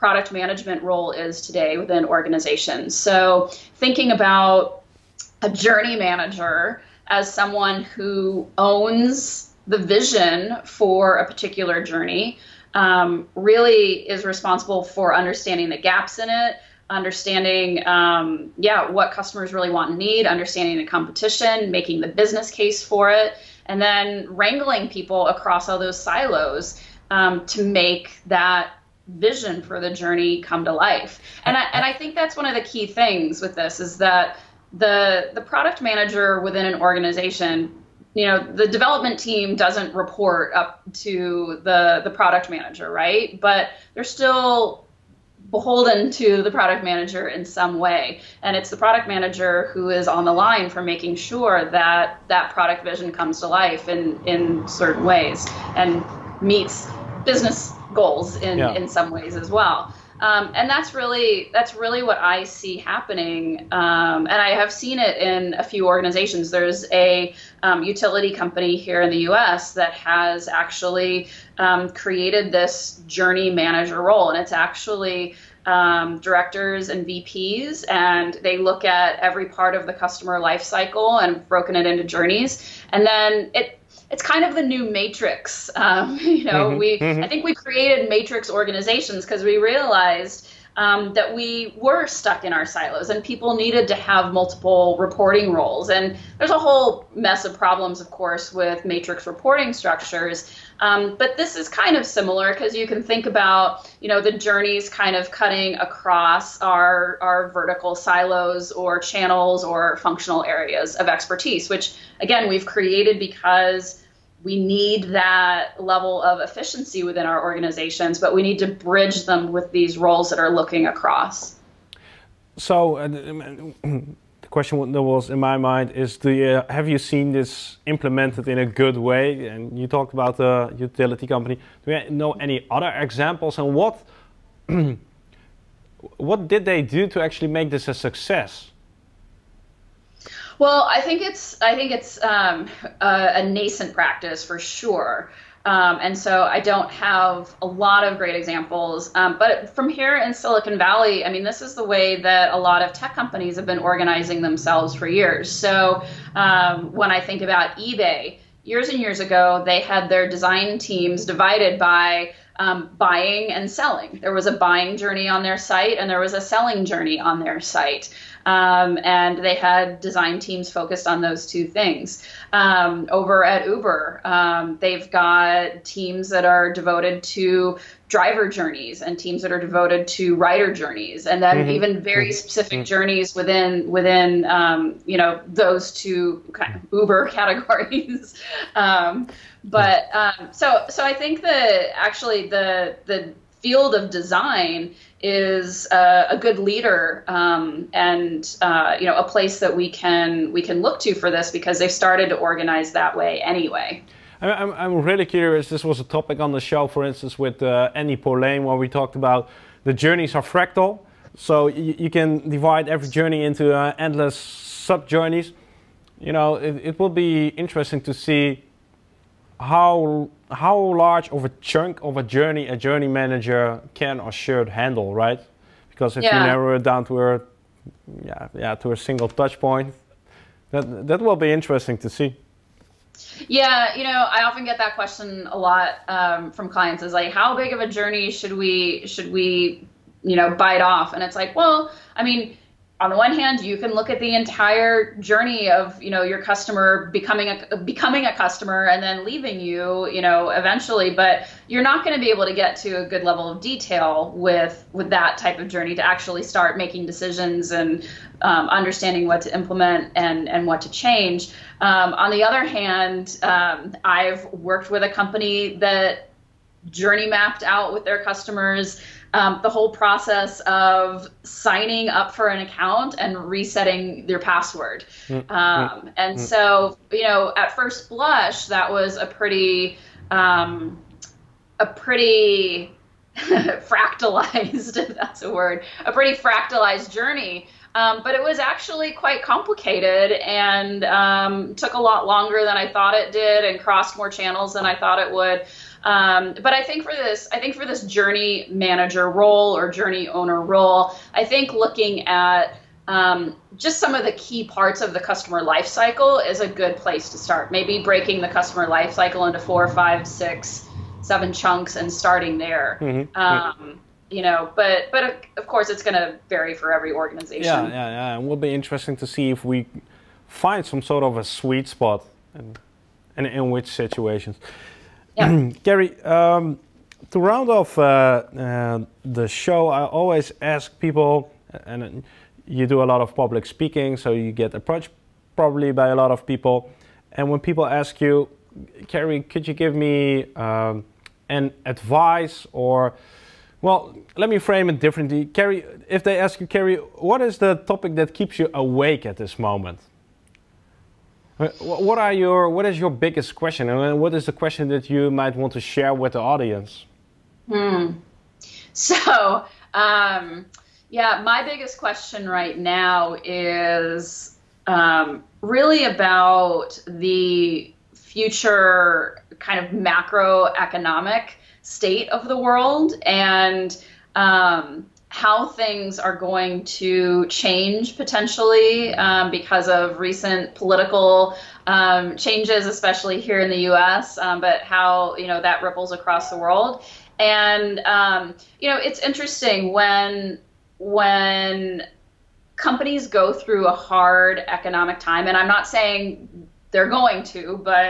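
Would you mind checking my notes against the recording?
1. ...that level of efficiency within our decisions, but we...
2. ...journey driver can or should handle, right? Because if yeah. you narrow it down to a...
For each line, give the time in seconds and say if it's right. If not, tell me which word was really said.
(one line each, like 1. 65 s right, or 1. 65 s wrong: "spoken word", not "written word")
1. 115 s wrong: "organizations", not "decisions"
2. 222 s wrong: "manager", not "driver".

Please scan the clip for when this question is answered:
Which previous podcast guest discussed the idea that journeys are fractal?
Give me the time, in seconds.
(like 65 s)
207 s.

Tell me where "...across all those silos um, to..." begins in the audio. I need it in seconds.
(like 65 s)
25 s.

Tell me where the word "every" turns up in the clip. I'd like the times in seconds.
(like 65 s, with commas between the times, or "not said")
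79 s, 212 s, 316 s.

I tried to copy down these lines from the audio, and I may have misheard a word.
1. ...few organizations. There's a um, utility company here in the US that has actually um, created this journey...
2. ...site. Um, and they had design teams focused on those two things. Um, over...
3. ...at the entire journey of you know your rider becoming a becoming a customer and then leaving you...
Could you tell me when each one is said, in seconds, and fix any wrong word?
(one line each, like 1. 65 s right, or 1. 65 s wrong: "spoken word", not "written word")
1. 65 s right
2. 167 s right
3. 244 s wrong: "customer", not "rider".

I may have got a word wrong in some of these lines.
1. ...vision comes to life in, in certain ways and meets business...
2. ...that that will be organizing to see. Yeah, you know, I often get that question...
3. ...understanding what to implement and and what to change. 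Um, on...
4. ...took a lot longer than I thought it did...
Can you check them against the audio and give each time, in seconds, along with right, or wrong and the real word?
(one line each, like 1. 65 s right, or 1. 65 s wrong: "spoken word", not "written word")
1. 52 s right
2. 230 s wrong: "interesting", not "organizing"
3. 258 s right
4. 291 s right.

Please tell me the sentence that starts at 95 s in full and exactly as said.
And there's a whole mess of problems, of course, with matrix reporting structures.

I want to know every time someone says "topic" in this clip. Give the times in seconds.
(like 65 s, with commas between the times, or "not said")
206 s, 347 s.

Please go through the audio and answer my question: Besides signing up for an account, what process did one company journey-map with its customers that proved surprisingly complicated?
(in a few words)
Resetting your password.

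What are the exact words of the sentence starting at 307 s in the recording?
Maybe breaking the customer life cycle into four, five, six, seven chunks and starting there.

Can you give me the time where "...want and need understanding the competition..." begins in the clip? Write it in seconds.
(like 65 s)
19 s.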